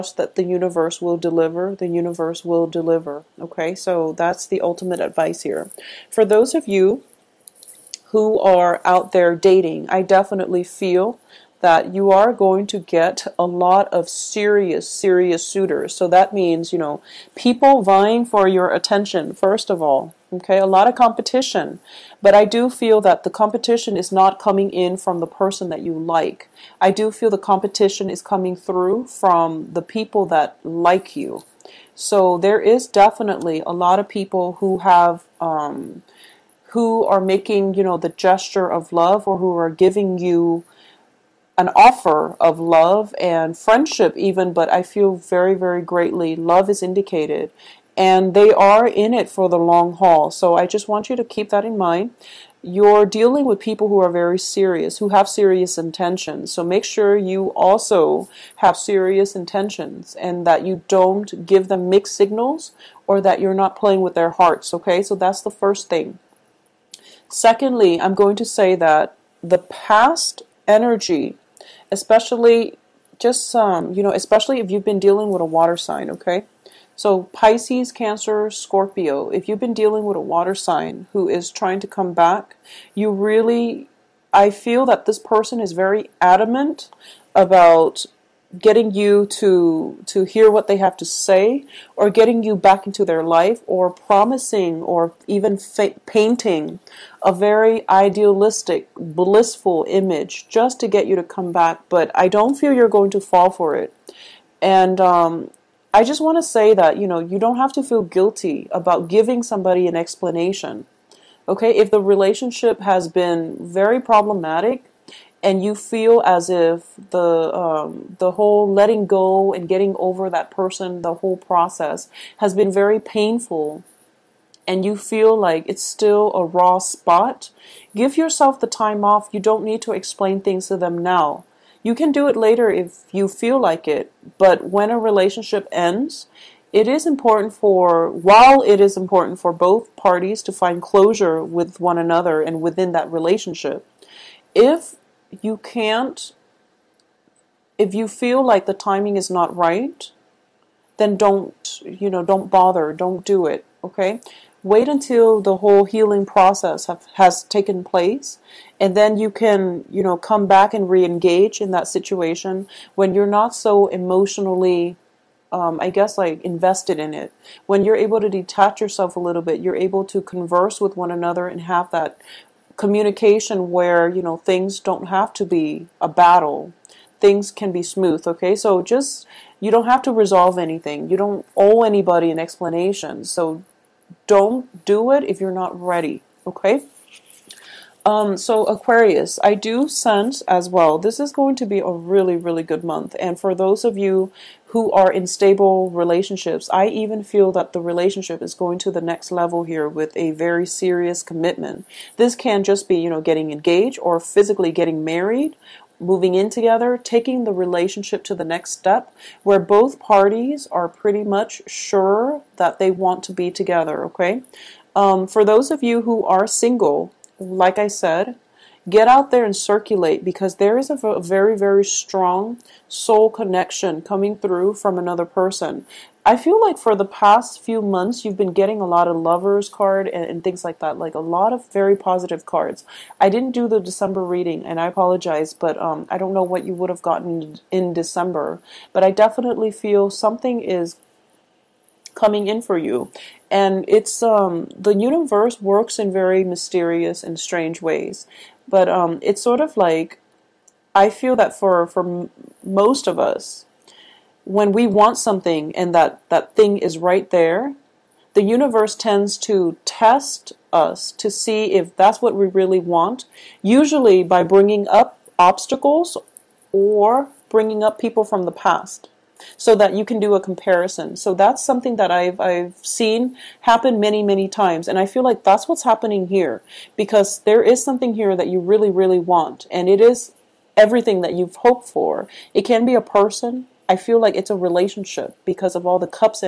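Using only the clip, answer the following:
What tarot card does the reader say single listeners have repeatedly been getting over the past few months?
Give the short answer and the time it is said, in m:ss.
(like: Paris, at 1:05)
lovers card, at 3:49.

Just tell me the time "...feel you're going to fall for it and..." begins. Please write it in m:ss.
1:42.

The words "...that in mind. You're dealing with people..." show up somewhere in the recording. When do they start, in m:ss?
0:51.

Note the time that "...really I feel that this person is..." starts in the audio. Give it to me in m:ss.
1:23.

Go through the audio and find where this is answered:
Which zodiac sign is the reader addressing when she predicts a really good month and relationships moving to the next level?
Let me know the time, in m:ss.
3:08.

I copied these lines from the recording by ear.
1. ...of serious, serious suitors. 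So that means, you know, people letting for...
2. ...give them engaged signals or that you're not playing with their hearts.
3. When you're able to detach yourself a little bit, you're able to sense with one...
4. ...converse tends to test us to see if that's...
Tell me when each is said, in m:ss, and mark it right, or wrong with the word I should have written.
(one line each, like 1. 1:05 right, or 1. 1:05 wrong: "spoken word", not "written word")
1. 0:13 wrong: "vying", not "letting"
2. 1:01 wrong: "mixed", not "engaged"
3. 2:47 wrong: "converse", not "sense"
4. 4:18 wrong: "universe", not "converse".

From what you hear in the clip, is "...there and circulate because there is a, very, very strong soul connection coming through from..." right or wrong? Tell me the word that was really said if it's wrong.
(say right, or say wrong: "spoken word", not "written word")
right.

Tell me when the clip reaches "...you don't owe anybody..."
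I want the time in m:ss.
3:01.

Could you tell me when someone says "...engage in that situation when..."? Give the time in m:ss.
2:41.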